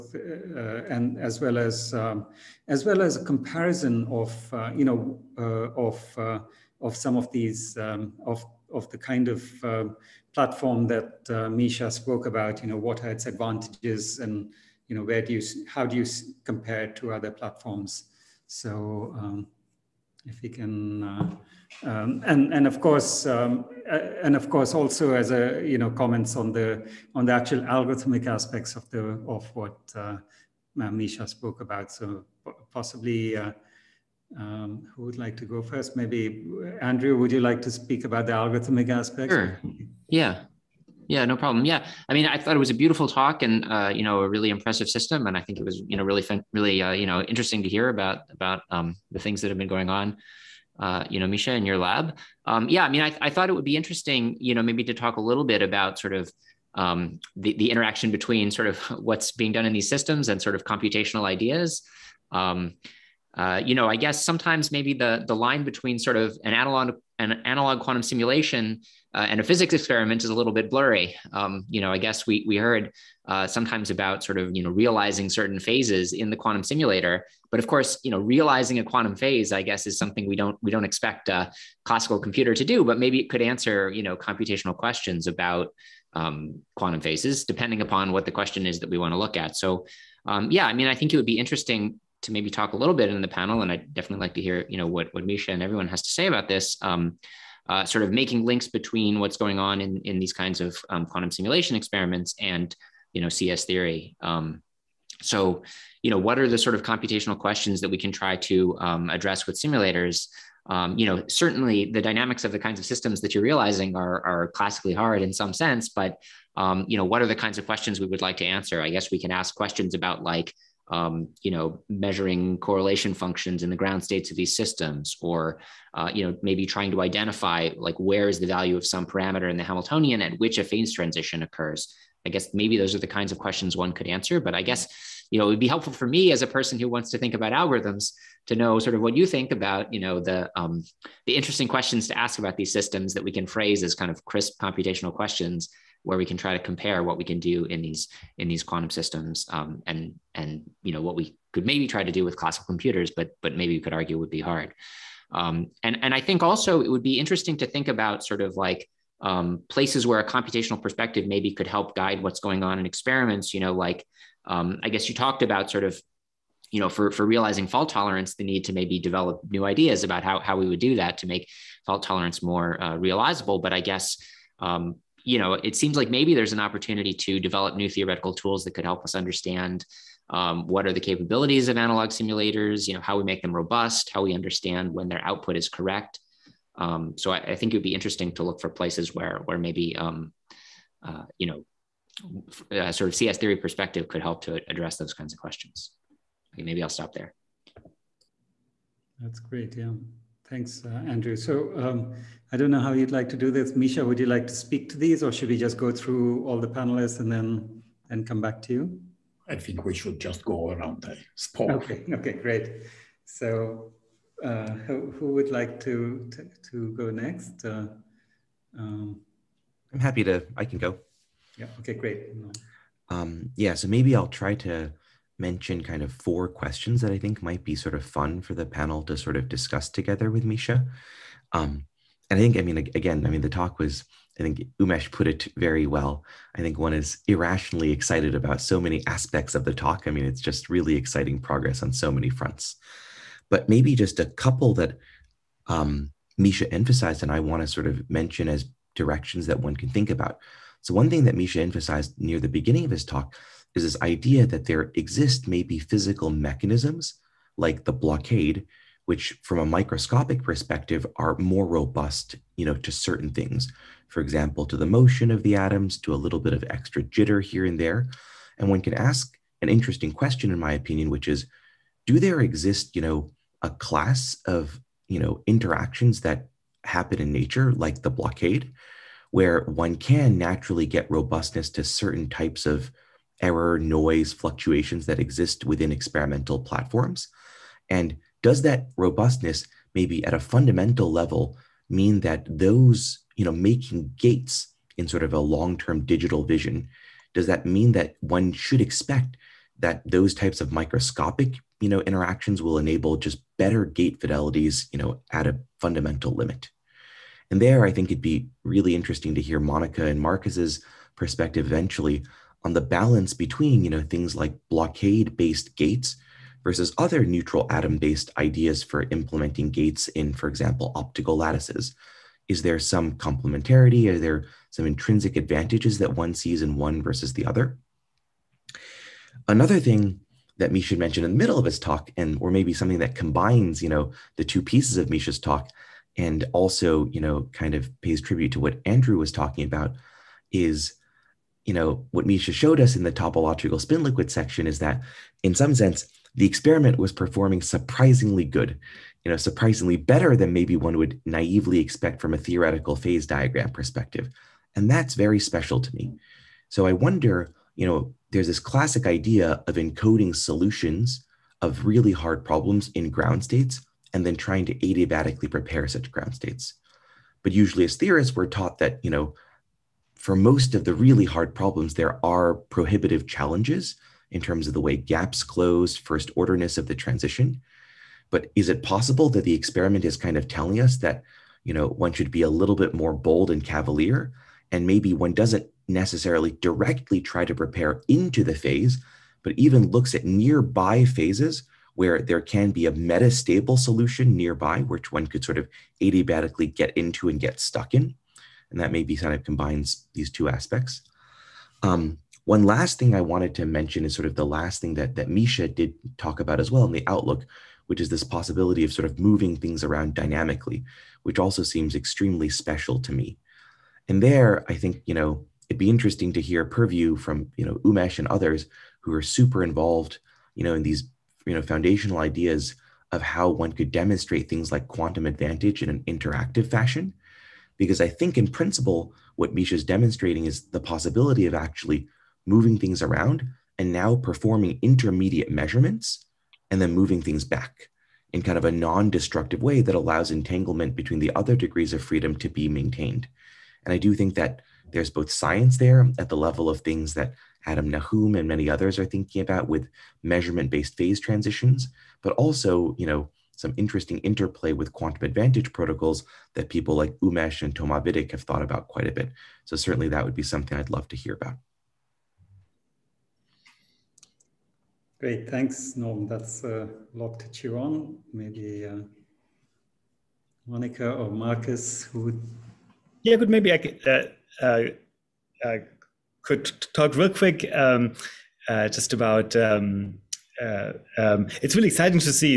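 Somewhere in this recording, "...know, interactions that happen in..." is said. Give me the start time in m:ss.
4:35.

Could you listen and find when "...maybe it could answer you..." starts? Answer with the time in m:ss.
1:22.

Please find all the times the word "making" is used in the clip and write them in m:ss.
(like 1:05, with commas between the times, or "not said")
1:38, 4:53.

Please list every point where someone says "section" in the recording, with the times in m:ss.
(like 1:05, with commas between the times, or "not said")
5:44.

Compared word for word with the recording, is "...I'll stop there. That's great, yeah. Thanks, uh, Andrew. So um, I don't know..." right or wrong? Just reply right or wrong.
right.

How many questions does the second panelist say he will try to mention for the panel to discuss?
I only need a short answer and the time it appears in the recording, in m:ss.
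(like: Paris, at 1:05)
4, at 3:46.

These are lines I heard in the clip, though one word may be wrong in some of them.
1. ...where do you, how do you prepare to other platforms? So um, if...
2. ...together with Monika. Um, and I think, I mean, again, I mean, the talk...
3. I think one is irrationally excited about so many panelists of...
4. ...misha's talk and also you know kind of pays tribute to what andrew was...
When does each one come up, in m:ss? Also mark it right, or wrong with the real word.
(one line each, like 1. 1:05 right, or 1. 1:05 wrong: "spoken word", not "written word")
1. 0:15 wrong: "compare", not "prepare"
2. 3:49 wrong: "Misha", not "Monika"
3. 3:56 wrong: "aspects", not "panelists"
4. 5:35 right.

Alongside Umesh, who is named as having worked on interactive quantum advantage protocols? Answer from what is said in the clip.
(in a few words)
Vidick.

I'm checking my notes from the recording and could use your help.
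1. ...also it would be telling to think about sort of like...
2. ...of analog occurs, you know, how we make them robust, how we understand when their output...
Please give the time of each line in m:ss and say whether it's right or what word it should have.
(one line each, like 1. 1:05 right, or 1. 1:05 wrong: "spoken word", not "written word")
1. 2:36 wrong: "interesting", not "telling"
2. 3:01 wrong: "simulators", not "occurs".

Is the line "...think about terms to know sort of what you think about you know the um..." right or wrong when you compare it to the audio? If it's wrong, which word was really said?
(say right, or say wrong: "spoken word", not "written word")
wrong: "algorithms", not "terms".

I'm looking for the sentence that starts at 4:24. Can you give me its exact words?
For example, to the motion of the atoms, to a little bit of extra jitter here and there.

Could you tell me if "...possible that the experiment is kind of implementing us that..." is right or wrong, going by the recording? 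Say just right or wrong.
wrong.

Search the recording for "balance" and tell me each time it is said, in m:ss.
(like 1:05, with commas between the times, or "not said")
5:12.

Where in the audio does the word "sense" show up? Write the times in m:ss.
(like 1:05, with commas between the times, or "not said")
1:55, 5:45.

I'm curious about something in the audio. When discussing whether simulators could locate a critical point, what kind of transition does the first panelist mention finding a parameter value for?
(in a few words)
Phase transition.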